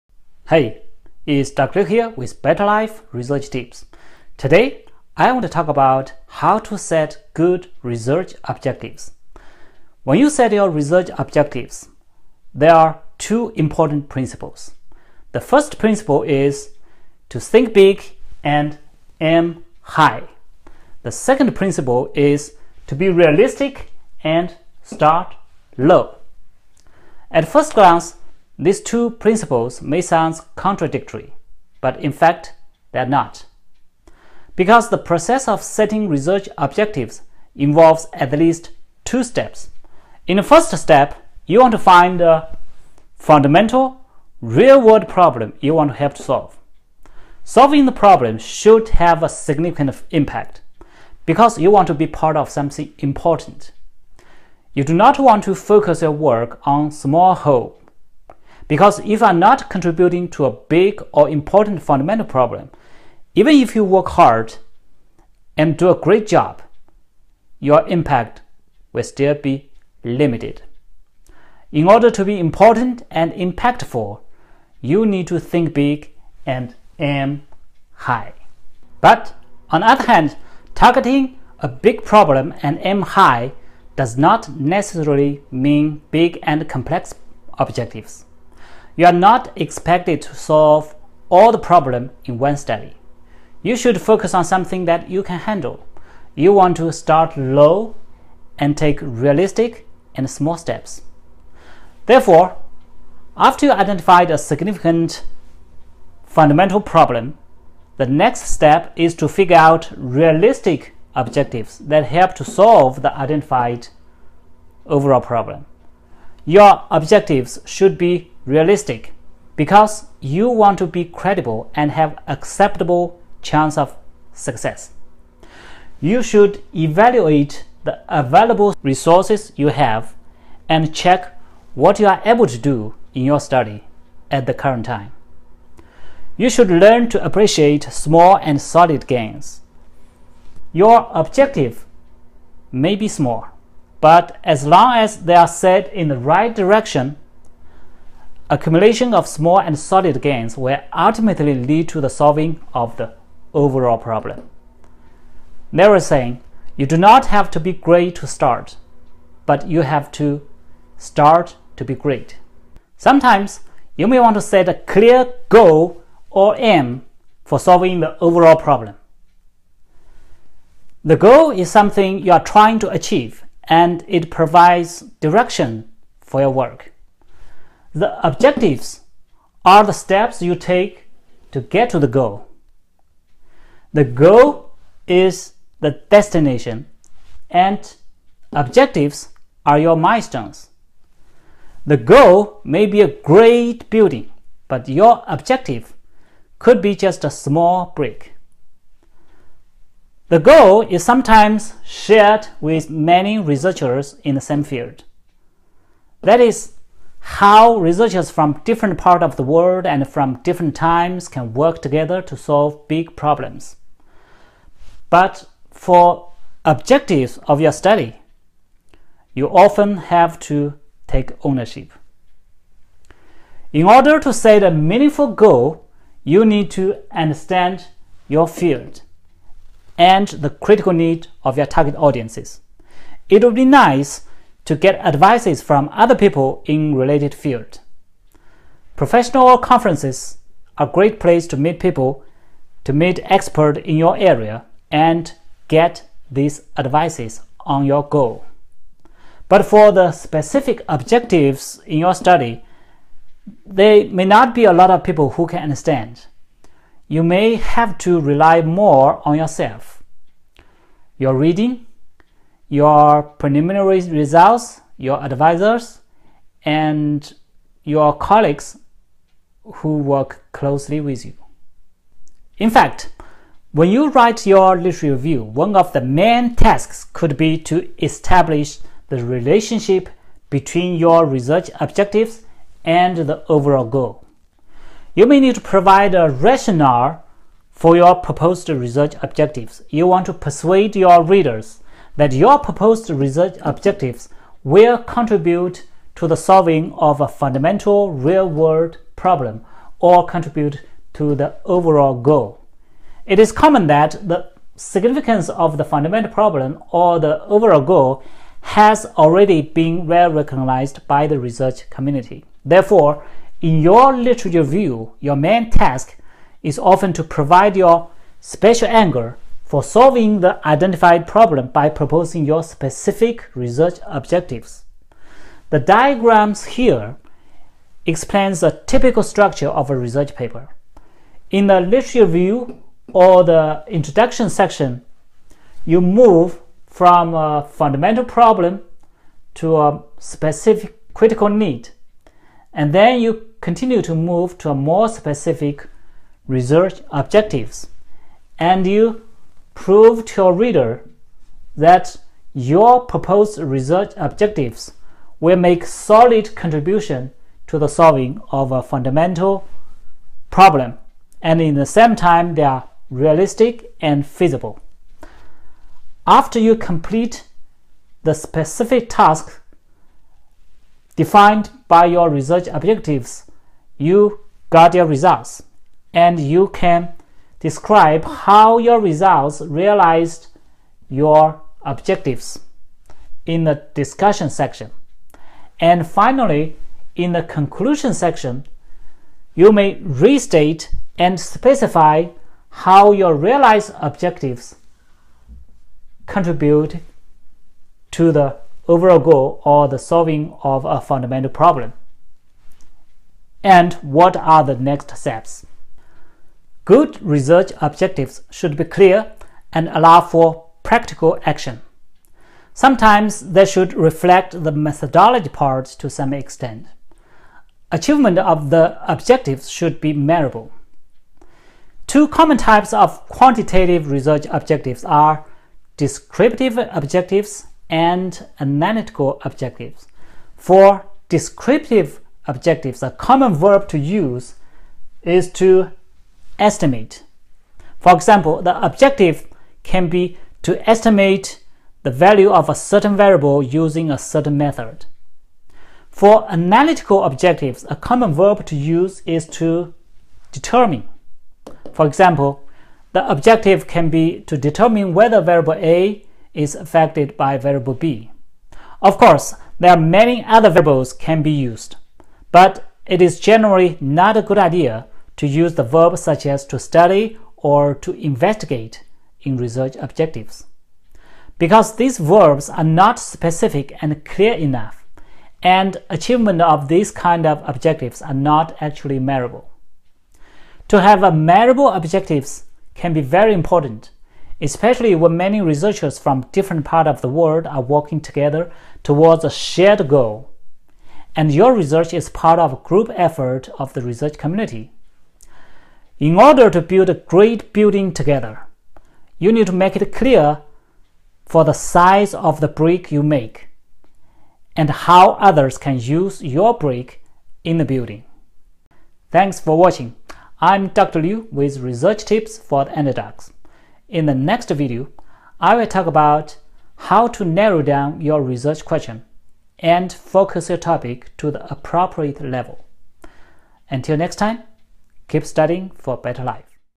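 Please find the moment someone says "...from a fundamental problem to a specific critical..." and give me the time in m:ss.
5:36.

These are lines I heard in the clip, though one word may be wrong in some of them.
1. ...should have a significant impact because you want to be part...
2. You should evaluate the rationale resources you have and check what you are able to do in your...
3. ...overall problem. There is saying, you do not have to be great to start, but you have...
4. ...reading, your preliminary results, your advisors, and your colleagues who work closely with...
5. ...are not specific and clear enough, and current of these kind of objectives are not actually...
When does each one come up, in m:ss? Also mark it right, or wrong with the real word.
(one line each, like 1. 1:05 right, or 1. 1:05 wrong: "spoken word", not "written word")
1. 0:48 right
2. 2:05 wrong: "available", not "rationale"
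3. 2:33 right
4. 4:21 right
5. 7:52 wrong: "achievement", not "current".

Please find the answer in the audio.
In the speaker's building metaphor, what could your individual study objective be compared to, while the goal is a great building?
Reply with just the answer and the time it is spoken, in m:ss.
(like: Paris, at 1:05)
A small brick, at 3:17.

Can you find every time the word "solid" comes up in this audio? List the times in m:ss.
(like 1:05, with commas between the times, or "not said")
2:18, 2:29, 5:55.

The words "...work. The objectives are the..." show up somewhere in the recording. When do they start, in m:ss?
2:56.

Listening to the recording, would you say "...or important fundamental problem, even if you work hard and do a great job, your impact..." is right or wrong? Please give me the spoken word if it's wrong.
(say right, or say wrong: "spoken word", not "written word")
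right.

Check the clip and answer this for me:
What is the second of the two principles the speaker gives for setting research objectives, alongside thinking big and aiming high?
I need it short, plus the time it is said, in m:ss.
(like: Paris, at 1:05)
Be realistic and start low, at 0:22.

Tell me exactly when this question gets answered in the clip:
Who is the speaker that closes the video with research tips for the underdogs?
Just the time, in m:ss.
8:30.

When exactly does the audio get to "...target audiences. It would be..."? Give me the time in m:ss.
3:51.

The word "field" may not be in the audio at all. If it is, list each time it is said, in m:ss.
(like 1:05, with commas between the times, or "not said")
3:24, 3:48, 3:57.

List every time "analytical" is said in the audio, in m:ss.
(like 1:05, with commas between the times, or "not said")
7:08, 7:26.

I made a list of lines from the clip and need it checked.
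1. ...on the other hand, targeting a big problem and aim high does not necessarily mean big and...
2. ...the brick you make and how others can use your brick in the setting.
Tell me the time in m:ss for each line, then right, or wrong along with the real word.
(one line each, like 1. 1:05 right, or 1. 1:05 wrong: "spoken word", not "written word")
1. 1:19 right
2. 8:22 wrong: "building", not "setting".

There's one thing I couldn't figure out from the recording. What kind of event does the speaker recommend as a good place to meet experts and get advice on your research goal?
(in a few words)
Professional conferences.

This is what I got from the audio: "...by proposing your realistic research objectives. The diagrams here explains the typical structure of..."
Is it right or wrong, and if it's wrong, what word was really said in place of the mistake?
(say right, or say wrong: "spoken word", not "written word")
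wrong: "specific", not "realistic".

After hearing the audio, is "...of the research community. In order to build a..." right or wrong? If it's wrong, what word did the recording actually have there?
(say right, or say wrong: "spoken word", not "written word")
right.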